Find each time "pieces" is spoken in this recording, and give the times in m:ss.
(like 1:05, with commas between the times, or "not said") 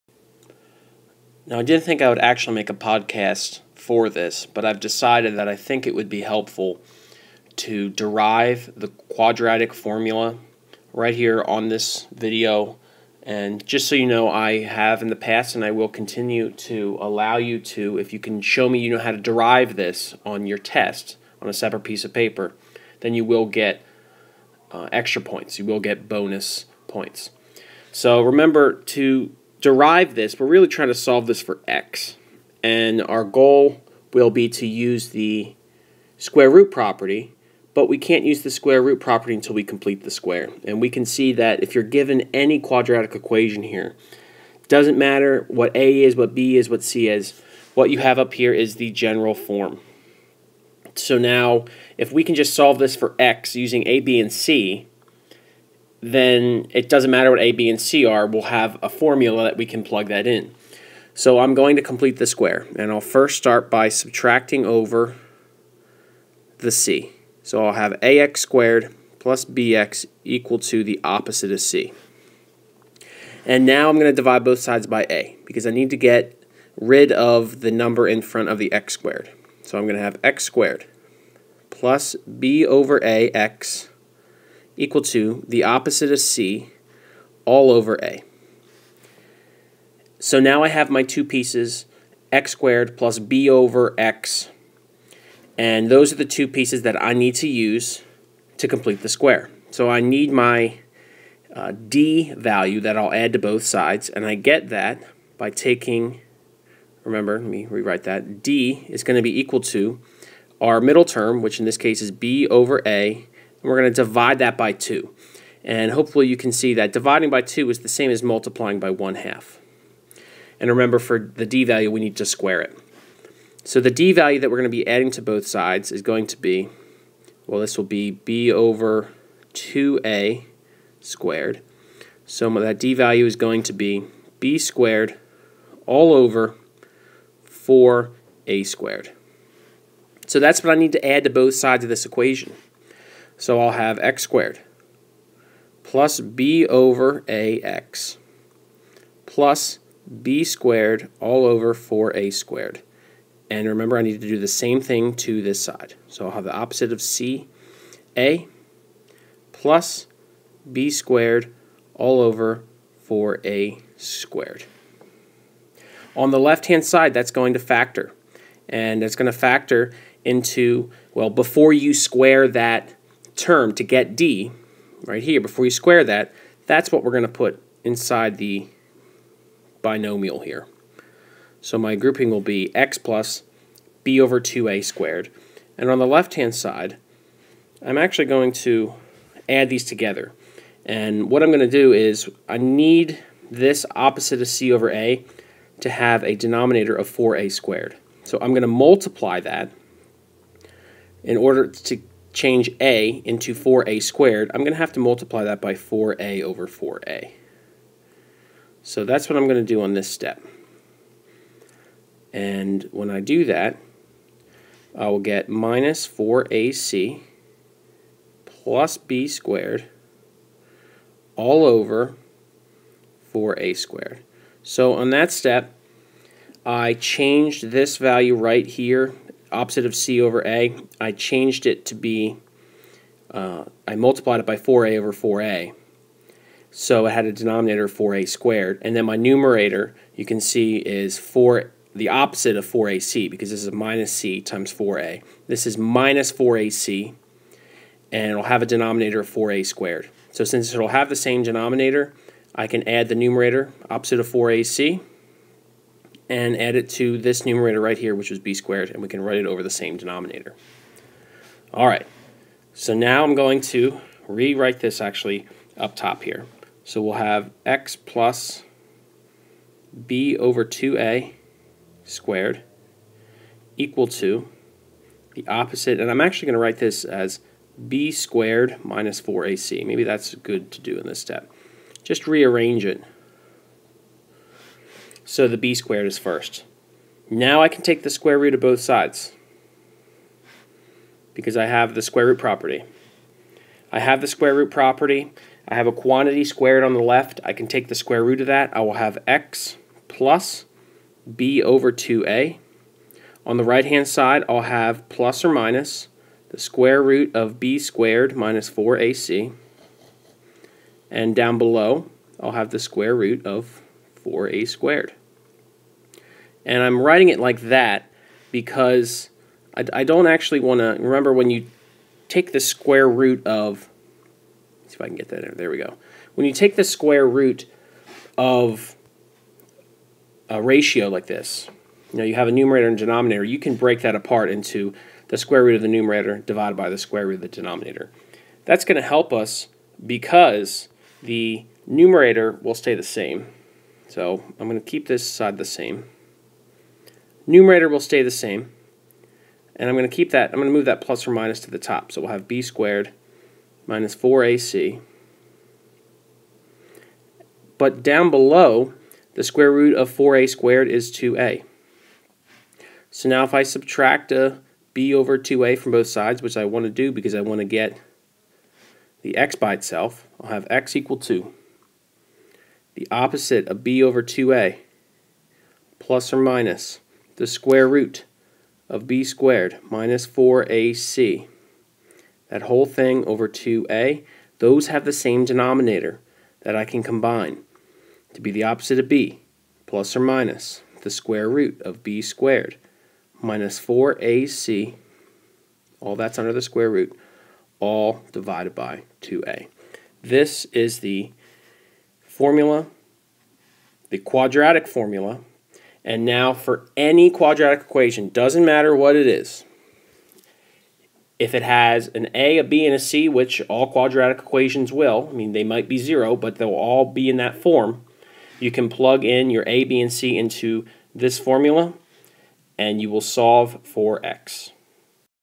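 0:21, 1:31, 1:36.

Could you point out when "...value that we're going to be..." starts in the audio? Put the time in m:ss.
2:04.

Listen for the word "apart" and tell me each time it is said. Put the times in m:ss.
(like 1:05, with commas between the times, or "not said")
5:34.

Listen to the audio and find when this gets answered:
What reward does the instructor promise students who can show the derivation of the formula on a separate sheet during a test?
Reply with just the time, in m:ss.
0:26.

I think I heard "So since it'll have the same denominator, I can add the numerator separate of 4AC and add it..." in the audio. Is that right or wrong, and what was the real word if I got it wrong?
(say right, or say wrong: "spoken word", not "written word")
wrong: "opposite", not "separate".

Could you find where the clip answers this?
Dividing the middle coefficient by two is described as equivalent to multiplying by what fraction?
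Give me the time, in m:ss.
1:58.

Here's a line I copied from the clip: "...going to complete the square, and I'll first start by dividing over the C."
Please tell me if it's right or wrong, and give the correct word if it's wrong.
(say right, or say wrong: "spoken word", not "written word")
wrong: "subtracting", not "dividing".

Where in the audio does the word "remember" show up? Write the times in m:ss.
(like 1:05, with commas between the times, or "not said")
0:28, 1:47, 2:00, 2:33, 5:21.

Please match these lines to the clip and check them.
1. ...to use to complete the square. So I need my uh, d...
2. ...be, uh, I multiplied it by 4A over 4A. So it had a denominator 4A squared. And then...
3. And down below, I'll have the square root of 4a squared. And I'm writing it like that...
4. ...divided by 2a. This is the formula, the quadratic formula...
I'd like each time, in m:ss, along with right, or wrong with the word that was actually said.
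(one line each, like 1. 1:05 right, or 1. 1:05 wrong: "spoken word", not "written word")
1. 1:37 right
2. 3:51 right
3. 5:11 right
4. 6:38 right.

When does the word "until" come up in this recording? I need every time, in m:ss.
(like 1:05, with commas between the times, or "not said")
0:39.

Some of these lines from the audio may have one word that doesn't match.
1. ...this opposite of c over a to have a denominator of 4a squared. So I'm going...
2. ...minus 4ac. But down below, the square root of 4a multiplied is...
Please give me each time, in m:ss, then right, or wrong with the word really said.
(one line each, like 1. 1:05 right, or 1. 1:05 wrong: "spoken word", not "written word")
1. 3:13 right
2. 5:53 wrong: "squared", not "multiplied".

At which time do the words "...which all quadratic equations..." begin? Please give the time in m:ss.
6:53.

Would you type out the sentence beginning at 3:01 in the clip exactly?
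So my grouping will be x plus b over 2a squared.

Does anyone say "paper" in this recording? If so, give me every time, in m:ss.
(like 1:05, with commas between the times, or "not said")
0:22.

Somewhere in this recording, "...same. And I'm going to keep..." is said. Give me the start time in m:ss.
5:48.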